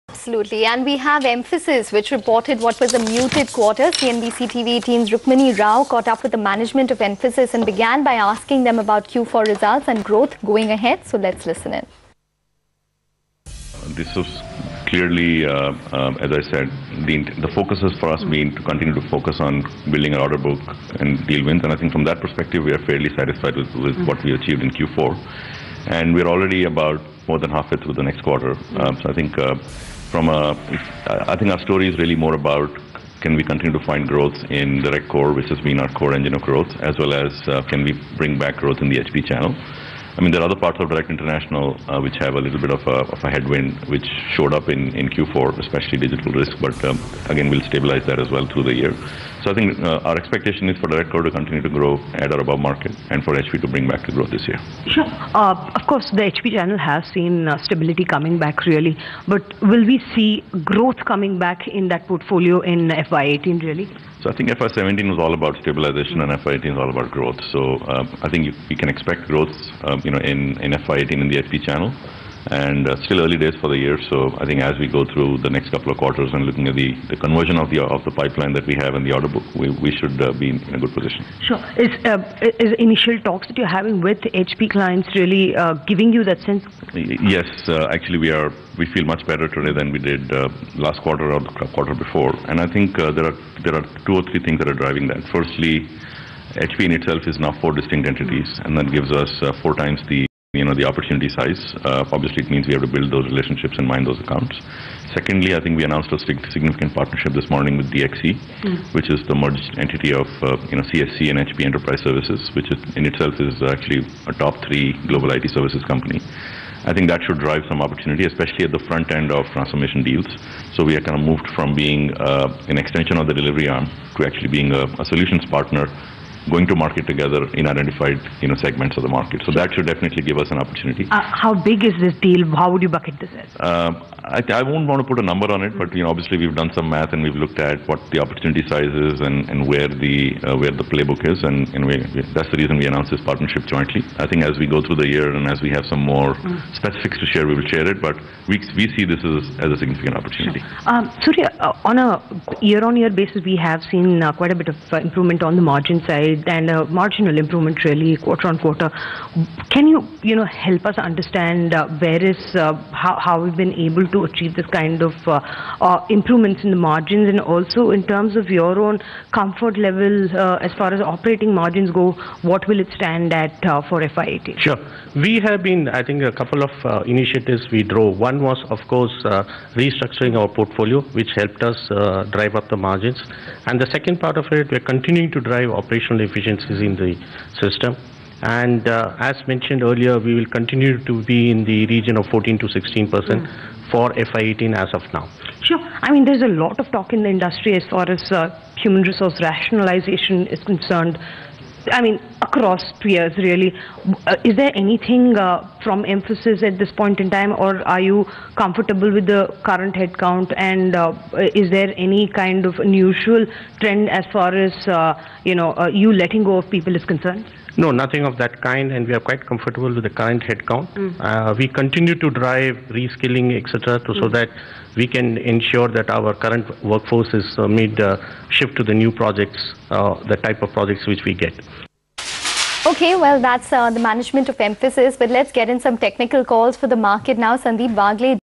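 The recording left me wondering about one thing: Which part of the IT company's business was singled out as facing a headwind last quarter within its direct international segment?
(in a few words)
Digital risk.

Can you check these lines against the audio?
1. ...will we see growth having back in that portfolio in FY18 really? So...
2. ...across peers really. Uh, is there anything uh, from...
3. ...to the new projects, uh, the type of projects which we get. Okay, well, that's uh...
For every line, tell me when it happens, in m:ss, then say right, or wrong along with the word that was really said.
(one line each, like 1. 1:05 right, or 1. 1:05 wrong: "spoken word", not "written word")
1. 0:59 wrong: "coming", not "having"
2. 3:22 right
3. 3:48 right.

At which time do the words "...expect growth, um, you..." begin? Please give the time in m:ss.
1:08.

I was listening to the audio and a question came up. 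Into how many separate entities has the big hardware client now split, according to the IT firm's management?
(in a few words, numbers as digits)
4.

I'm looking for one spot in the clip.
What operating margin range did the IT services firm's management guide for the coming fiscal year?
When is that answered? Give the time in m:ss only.
3:12.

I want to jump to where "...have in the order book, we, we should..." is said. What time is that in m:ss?
1:18.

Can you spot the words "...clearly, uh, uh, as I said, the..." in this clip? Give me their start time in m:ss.
0:14.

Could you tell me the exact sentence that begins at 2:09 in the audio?
So that should definitely give us an opportunity.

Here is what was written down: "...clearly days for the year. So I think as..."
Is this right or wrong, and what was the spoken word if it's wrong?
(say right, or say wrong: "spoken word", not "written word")
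wrong: "early", not "clearly".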